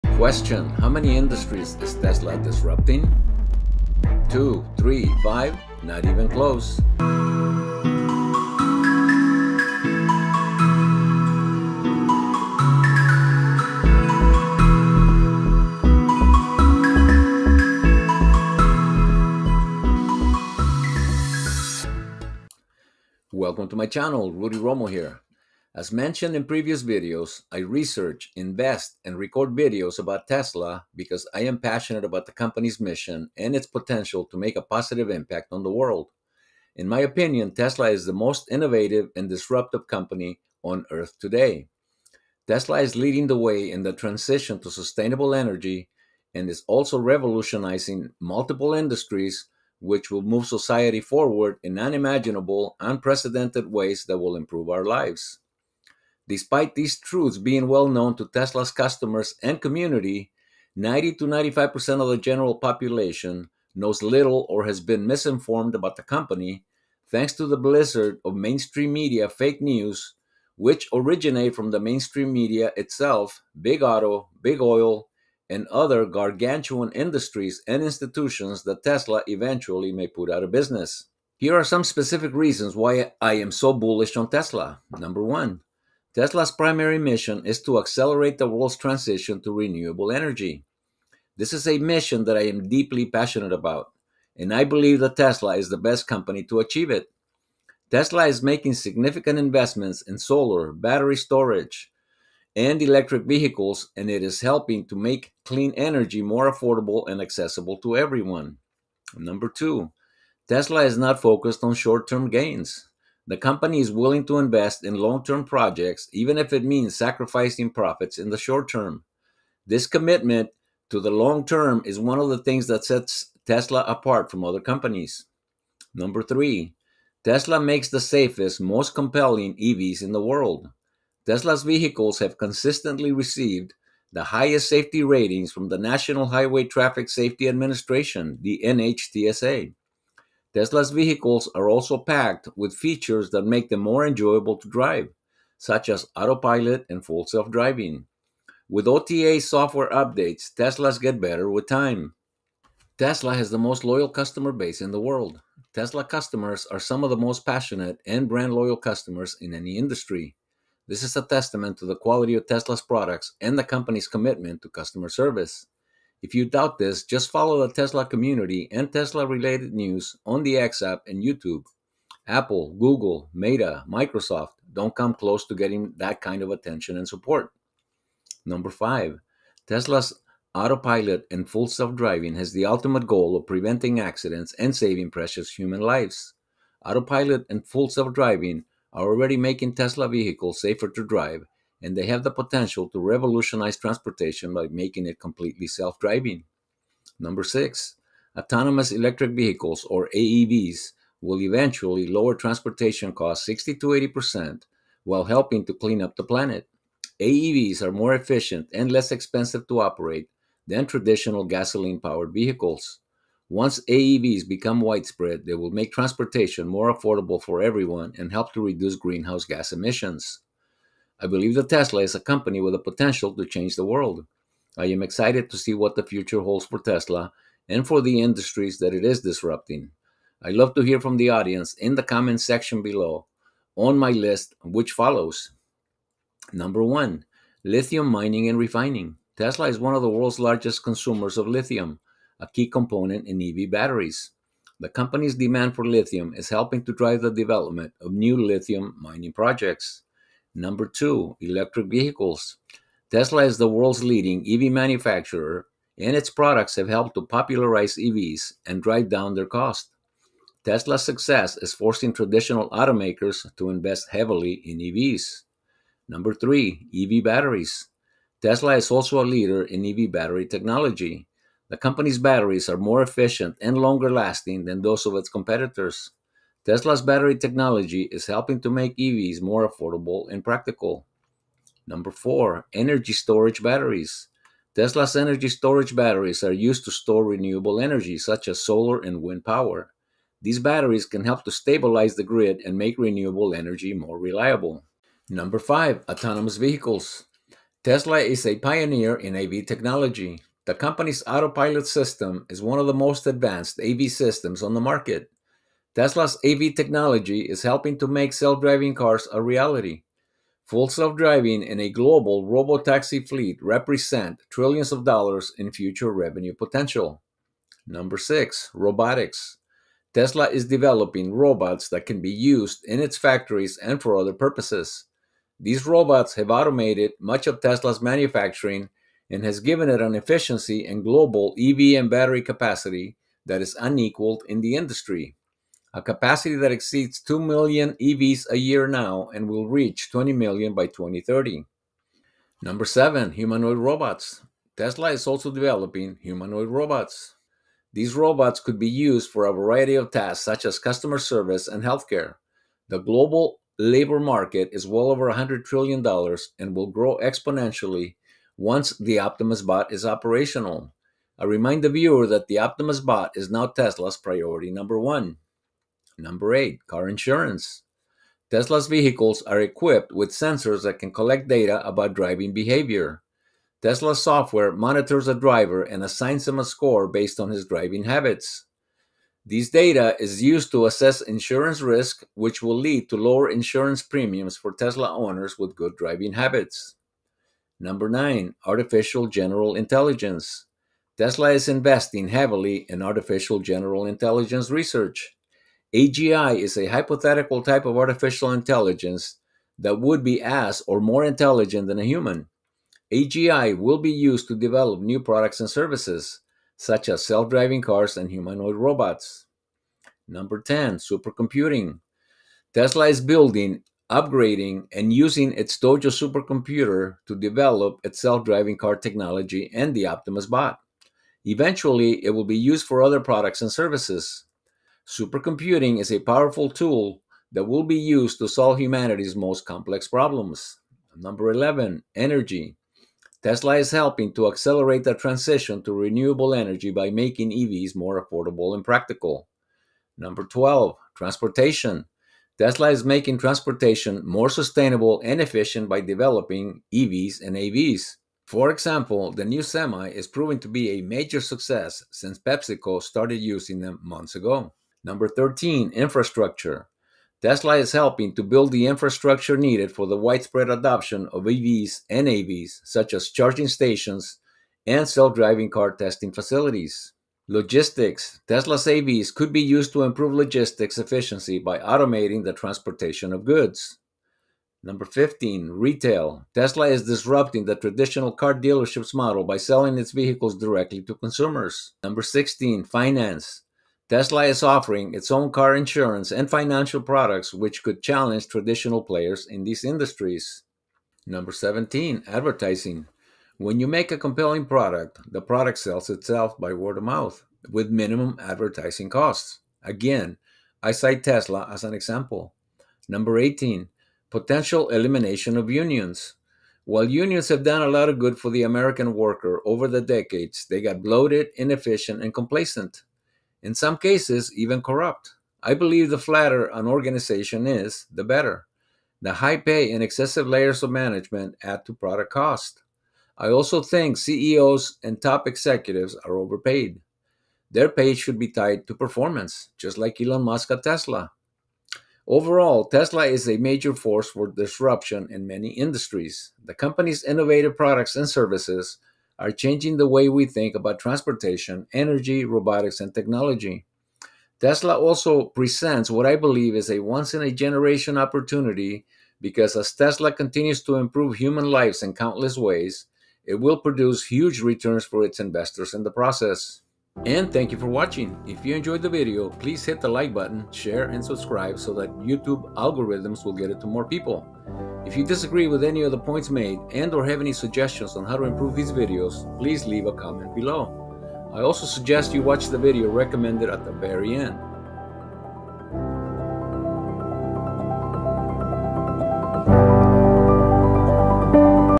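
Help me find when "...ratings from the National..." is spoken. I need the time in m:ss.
2:15.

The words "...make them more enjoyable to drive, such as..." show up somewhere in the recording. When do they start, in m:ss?
2:23.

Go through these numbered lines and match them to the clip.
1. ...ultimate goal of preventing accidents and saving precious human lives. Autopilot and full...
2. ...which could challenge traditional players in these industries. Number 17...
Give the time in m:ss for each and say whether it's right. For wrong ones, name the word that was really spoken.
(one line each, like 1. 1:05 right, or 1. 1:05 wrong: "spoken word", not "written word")
1. 3:02 right
2. 8:07 right.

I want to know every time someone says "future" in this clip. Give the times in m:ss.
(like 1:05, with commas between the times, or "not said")
3:46, 5:15.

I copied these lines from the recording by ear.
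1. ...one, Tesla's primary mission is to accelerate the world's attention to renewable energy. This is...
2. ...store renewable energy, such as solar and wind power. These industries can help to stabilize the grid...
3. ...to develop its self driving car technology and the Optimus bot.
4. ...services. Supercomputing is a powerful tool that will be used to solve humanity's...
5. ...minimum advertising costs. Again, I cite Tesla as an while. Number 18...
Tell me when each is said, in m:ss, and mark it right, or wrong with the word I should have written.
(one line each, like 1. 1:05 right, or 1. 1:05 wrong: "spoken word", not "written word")
1. 1:25 wrong: "transition", not "attention"
2. 4:46 wrong: "batteries", not "industries"
3. 6:57 right
4. 7:03 right
5. 8:17 wrong: "example", not "while".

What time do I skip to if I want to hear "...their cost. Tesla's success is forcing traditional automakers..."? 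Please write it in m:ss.
4:19.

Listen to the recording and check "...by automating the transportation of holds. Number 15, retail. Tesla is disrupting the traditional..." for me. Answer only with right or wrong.
wrong.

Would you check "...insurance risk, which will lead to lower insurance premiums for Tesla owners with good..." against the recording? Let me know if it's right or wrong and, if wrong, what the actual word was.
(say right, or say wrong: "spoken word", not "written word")
right.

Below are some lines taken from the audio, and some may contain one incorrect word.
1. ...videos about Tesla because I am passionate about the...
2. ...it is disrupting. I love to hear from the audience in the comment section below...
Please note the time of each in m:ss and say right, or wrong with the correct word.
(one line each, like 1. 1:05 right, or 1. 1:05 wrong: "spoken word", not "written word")
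1. 0:29 right
2. 3:48 right.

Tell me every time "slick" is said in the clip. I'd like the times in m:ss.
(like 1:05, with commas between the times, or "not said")
not said.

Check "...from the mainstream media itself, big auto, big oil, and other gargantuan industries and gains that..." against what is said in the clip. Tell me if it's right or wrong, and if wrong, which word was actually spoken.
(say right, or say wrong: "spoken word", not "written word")
wrong: "institutions", not "gains".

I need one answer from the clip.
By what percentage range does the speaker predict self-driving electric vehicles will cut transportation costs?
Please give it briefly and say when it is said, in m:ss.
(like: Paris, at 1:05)
60 to 80%, at 3:23.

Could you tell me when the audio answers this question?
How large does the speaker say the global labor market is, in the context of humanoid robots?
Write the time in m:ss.
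5:54.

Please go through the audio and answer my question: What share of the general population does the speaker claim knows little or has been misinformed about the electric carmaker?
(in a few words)
90 to 95%.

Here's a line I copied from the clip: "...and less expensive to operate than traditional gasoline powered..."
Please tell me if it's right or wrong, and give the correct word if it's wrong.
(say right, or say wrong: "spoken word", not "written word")
right.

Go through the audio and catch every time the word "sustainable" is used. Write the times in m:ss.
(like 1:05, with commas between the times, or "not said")
0:44, 7:24.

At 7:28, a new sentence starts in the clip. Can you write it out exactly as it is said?
For example, the new semi is proving to be a major success since PepsiCo started using them months ago.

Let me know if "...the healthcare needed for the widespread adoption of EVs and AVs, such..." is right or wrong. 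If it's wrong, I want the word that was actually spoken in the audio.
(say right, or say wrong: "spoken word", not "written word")
wrong: "infrastructure", not "healthcare".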